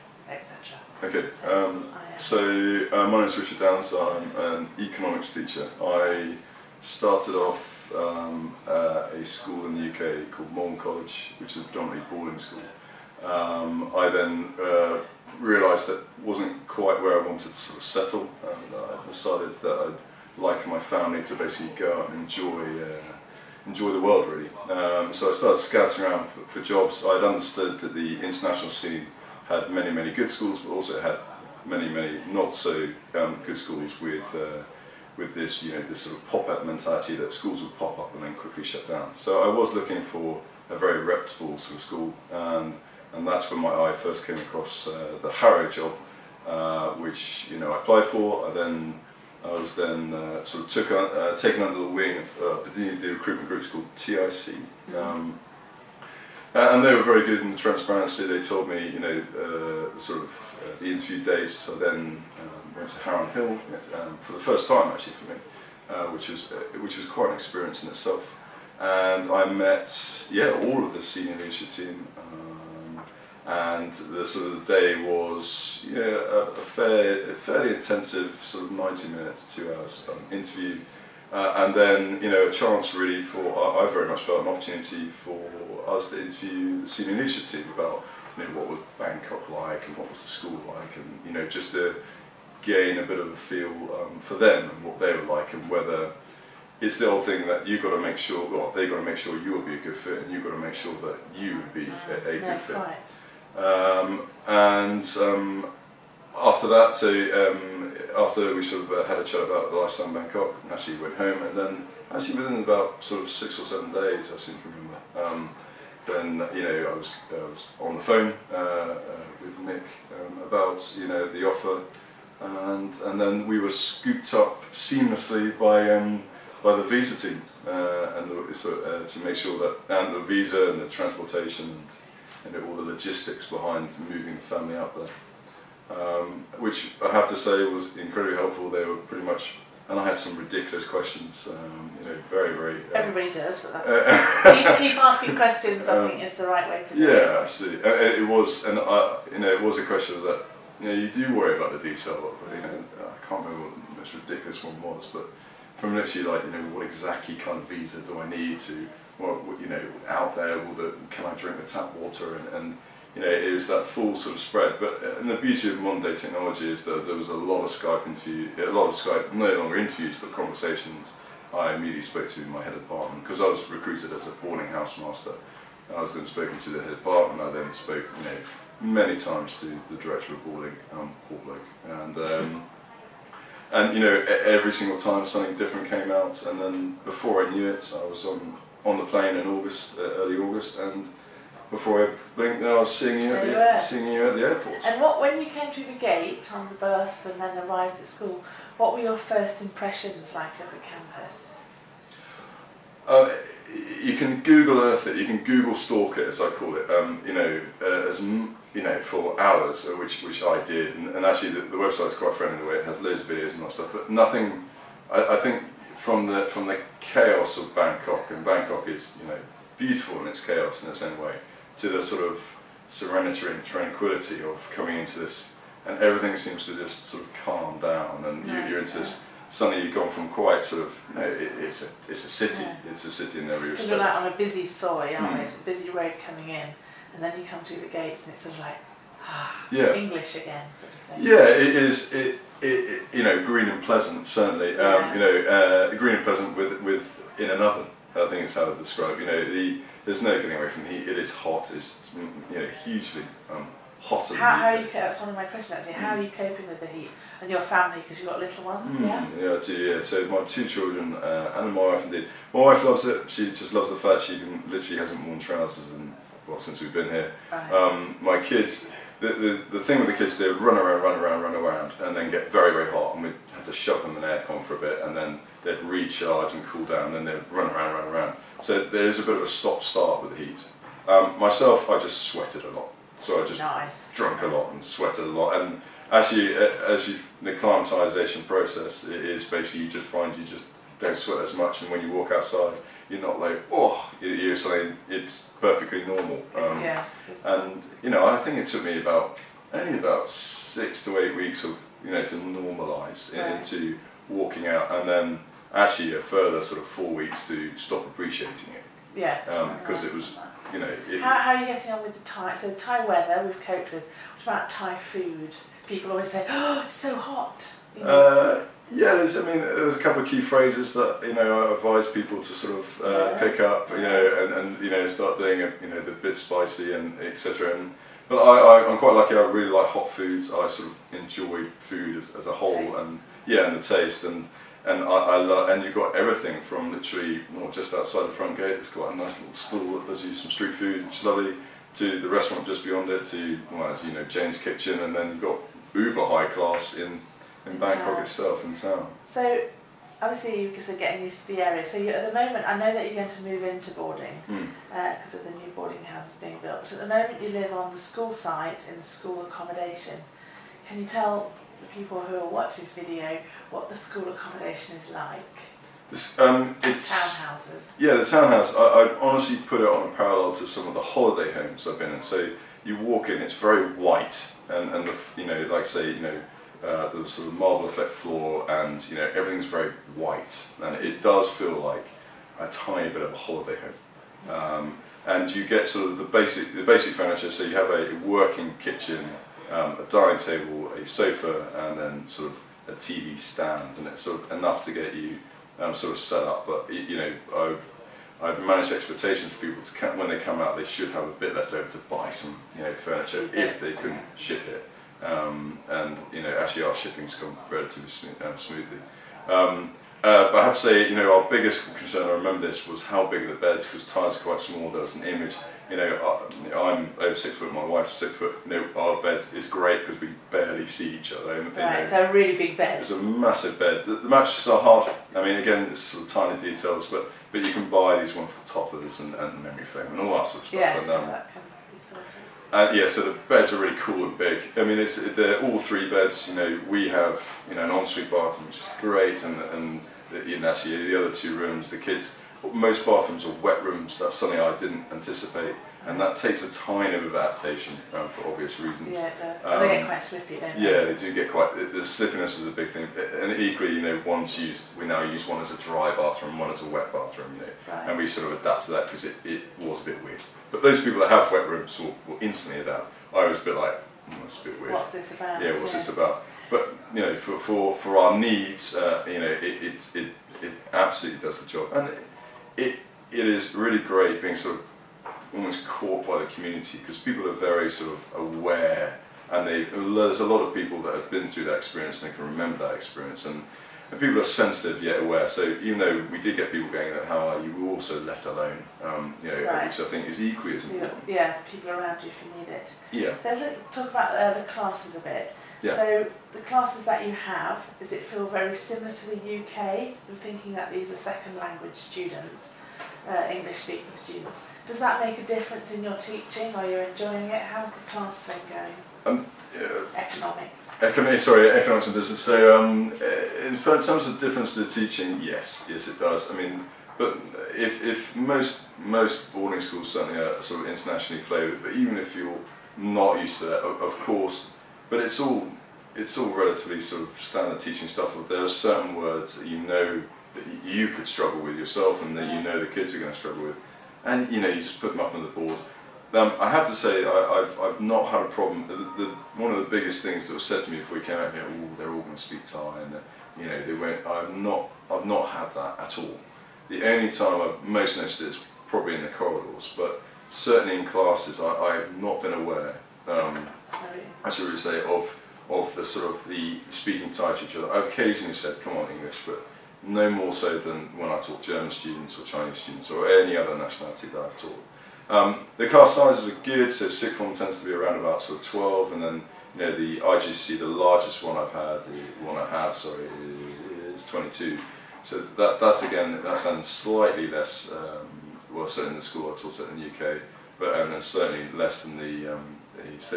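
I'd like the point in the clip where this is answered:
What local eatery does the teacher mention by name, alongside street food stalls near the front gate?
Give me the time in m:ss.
5:44.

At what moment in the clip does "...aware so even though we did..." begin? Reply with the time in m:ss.
8:05.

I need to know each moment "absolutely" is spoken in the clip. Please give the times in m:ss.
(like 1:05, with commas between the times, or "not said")
2:27, 7:50.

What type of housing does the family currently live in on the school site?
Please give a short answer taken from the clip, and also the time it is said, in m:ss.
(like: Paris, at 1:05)
Townhouses, at 6:07.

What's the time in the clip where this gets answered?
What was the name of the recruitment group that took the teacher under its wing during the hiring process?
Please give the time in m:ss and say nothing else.
0:53.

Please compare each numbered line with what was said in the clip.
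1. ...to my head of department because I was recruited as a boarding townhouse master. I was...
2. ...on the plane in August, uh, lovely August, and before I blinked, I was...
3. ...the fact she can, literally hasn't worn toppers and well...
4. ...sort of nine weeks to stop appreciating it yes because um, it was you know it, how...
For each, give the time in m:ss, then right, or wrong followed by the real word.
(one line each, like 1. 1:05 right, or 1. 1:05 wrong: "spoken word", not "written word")
1. 2:52 wrong: "house", not "townhouse"
2. 3:08 wrong: "early", not "lovely"
3. 4:23 wrong: "trousers", not "toppers"
4. 5:06 wrong: "four", not "nine".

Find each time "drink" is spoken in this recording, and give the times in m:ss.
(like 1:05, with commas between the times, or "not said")
2:41.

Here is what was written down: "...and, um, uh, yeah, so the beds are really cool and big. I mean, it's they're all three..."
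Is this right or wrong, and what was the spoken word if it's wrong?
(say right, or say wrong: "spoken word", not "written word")
right.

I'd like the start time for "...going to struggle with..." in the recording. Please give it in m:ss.
8:53.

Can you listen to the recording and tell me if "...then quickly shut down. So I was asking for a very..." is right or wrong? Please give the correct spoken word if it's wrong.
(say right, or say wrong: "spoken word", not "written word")
wrong: "looking", not "asking".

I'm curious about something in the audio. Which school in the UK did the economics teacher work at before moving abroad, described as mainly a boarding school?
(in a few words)
Malvern College.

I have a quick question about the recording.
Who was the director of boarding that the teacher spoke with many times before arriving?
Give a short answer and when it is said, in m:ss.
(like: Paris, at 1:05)
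Paul Blake, at 3:01.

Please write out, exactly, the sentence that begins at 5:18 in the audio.
uh, yeah, there's, I mean, there's a couple of key phrases that you know I advise people to sort of uh, yeah.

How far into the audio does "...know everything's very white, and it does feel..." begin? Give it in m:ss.
6:19.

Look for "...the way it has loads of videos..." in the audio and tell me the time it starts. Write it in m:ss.
3:32.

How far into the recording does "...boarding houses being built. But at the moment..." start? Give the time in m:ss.
5:55.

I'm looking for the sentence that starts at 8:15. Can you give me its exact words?
So the classes that you have, does it feel very similar to the UK?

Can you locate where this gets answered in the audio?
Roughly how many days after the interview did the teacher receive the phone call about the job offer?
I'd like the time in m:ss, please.
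1:53.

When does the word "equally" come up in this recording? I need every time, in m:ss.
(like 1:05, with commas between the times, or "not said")
7:33, 8:10.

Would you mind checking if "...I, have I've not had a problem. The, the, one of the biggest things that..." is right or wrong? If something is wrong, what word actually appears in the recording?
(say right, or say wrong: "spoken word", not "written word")
right.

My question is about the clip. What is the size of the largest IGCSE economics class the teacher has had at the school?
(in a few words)
22.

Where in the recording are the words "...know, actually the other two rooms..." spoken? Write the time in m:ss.
7:20.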